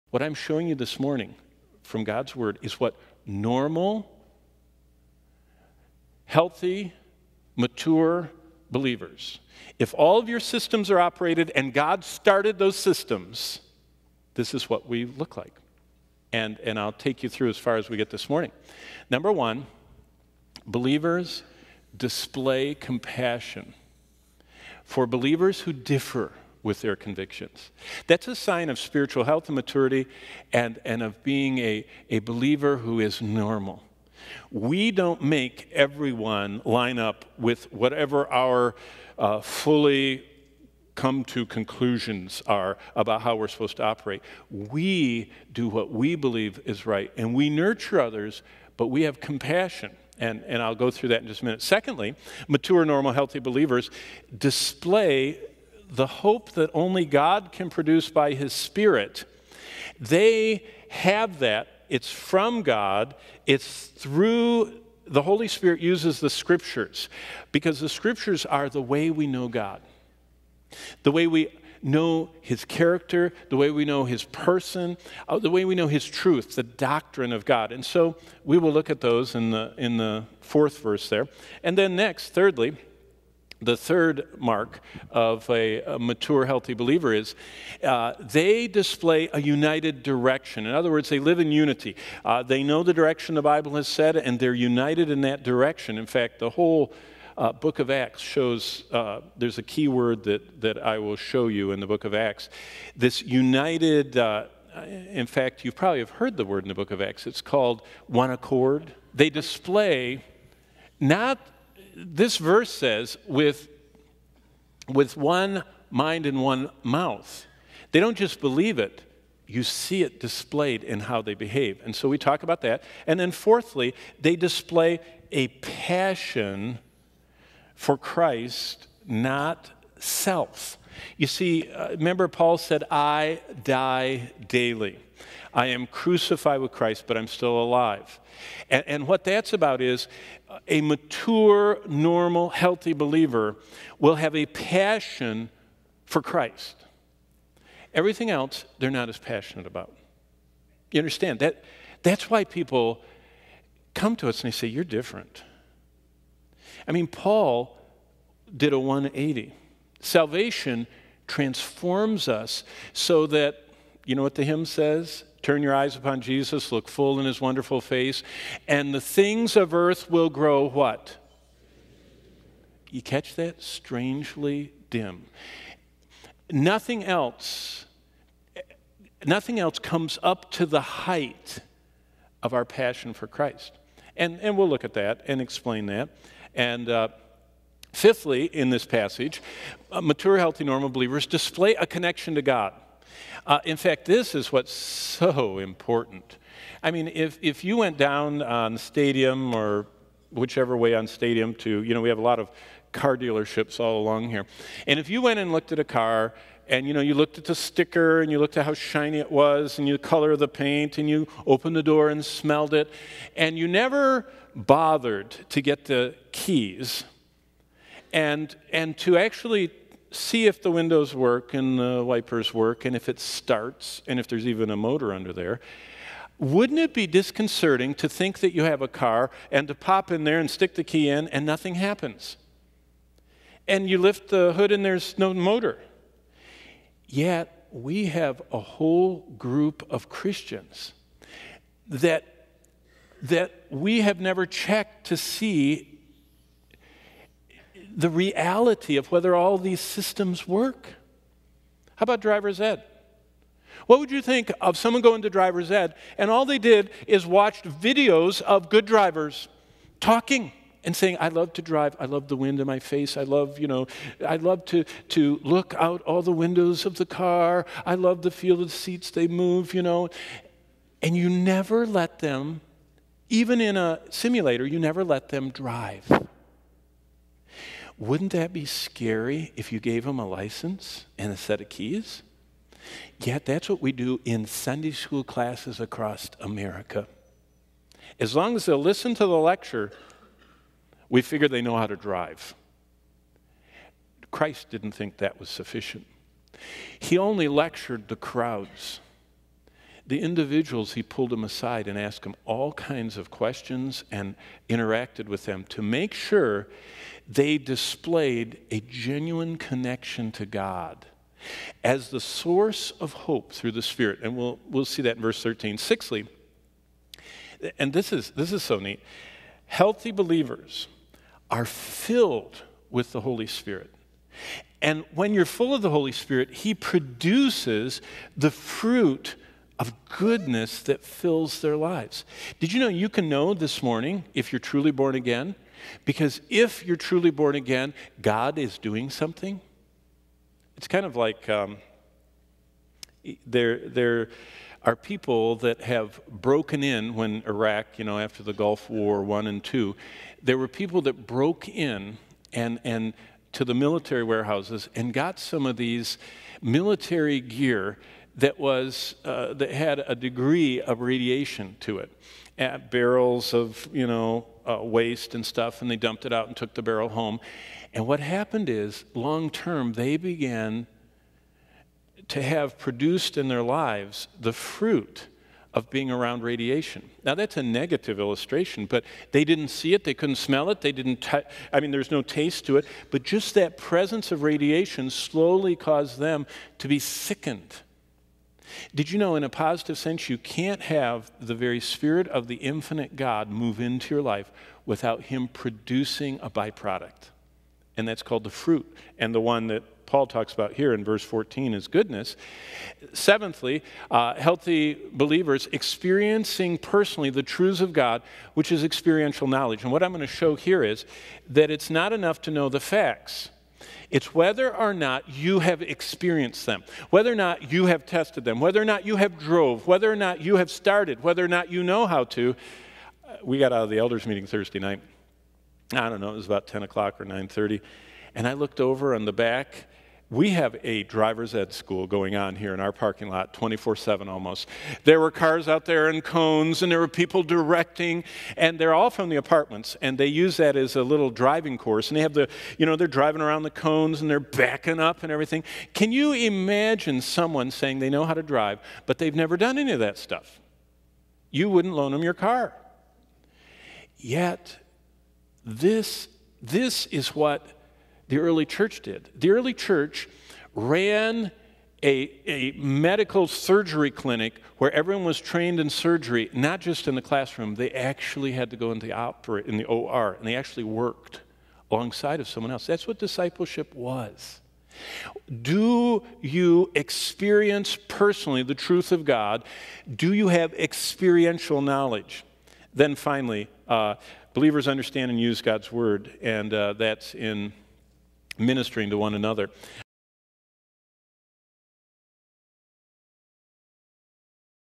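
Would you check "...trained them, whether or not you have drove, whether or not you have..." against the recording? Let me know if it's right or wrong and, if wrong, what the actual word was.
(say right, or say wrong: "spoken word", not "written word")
wrong: "tested", not "trained".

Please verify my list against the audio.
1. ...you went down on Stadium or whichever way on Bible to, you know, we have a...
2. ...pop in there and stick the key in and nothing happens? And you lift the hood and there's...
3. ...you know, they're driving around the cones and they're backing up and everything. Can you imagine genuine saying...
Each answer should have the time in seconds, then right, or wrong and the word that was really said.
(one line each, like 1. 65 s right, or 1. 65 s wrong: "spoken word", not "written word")
1. 197 s wrong: "Stadium", not "Bible"
2. 229 s right
3. 442 s wrong: "someone", not "genuine".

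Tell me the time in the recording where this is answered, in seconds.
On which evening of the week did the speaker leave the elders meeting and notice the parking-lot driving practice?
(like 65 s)
424 s.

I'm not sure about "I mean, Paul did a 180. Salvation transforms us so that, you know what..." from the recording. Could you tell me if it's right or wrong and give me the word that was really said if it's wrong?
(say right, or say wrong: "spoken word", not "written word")
right.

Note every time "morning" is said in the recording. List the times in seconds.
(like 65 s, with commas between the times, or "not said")
0 s, 18 s, 333 s.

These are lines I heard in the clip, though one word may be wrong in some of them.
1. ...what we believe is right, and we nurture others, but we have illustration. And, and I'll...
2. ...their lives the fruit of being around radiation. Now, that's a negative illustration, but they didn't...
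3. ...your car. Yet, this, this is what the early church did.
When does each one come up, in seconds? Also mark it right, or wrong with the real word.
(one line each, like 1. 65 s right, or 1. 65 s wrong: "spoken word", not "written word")
1. 45 s wrong: "compassion", not "illustration"
2. 373 s right
3. 452 s right.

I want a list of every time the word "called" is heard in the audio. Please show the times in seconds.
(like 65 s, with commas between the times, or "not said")
107 s, 398 s.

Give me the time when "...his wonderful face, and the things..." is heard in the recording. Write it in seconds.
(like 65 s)
167 s.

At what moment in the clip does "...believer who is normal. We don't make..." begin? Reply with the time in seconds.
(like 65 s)
32 s.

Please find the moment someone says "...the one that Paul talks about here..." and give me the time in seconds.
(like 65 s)
399 s.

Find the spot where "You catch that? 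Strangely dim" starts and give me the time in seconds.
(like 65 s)
172 s.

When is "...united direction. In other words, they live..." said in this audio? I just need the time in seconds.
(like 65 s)
89 s.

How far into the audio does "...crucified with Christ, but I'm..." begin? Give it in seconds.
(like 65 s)
135 s.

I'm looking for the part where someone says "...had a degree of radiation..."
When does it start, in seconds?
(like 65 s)
359 s.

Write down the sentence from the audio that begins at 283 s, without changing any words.
Yet that's what we do in Sunday school classes across America.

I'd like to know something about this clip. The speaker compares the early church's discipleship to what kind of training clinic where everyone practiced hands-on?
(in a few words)
medical surgery clinic.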